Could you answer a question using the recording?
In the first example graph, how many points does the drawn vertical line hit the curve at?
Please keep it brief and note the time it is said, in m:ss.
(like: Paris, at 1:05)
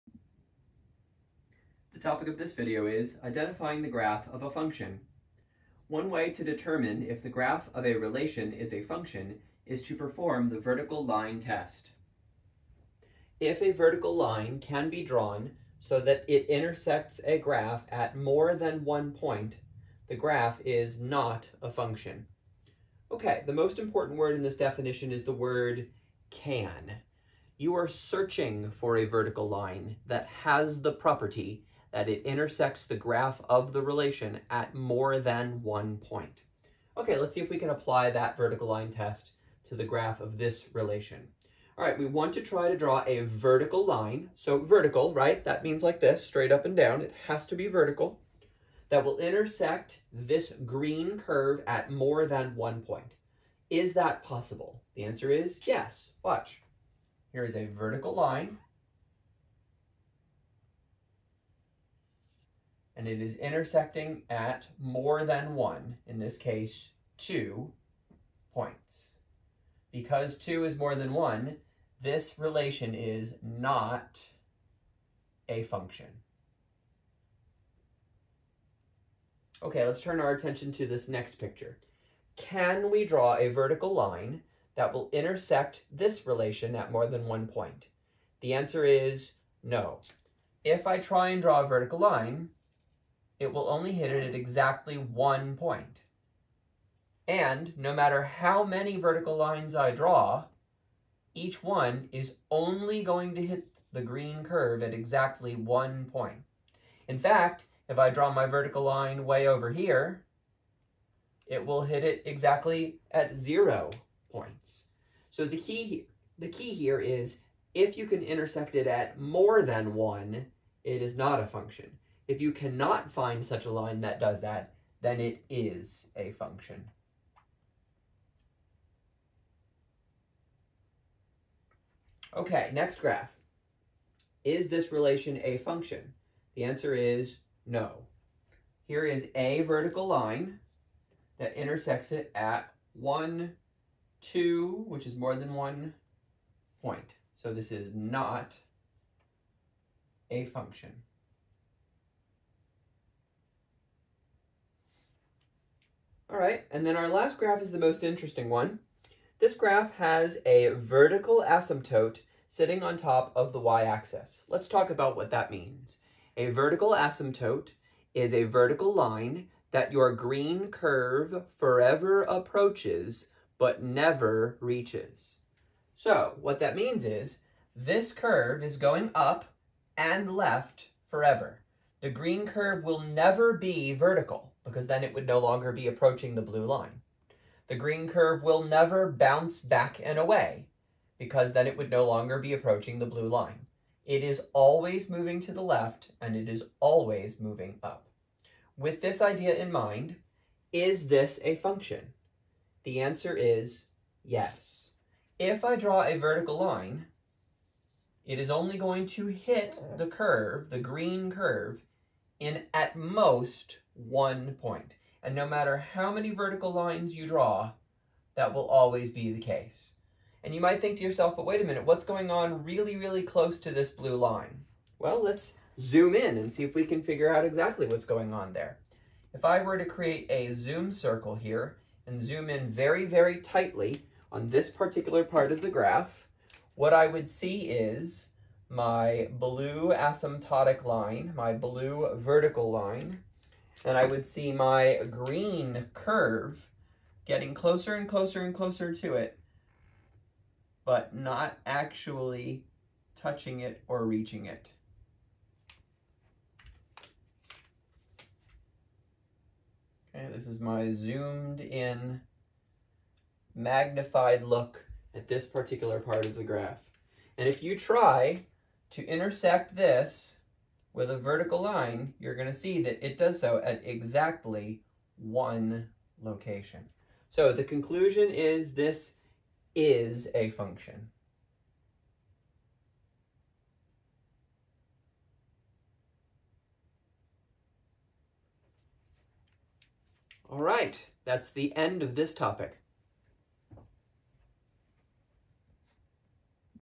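2, at 1:07.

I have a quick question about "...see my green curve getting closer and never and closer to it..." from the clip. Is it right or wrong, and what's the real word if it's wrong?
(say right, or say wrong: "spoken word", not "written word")
wrong: "closer", not "never".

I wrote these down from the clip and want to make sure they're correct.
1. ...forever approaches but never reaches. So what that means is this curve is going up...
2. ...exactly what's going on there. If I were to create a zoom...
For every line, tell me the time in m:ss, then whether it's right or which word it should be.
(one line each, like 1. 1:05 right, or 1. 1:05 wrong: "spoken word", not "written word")
1. 2:51 right
2. 3:47 right.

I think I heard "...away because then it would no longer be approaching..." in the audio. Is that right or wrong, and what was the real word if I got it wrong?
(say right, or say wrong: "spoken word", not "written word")
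right.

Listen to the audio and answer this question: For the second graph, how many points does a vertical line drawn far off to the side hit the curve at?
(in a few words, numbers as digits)
0.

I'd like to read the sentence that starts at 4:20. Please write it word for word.
Okay, this is my zoomed in, magnified look at this particular part of the graph.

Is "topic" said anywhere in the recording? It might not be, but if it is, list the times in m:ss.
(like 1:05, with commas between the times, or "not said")
0:02, 4:52.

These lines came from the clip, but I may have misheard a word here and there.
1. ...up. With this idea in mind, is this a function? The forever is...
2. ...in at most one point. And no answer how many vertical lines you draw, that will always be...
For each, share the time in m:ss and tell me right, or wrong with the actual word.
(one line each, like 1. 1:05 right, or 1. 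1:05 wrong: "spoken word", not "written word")
1. 3:17 wrong: "answer", not "forever"
2. 3:32 wrong: "matter", not "answer".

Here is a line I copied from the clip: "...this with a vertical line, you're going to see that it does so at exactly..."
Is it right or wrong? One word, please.
right.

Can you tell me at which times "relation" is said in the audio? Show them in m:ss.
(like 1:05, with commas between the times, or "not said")
0:07, 0:33, 0:40, 1:12, 1:26, 2:14.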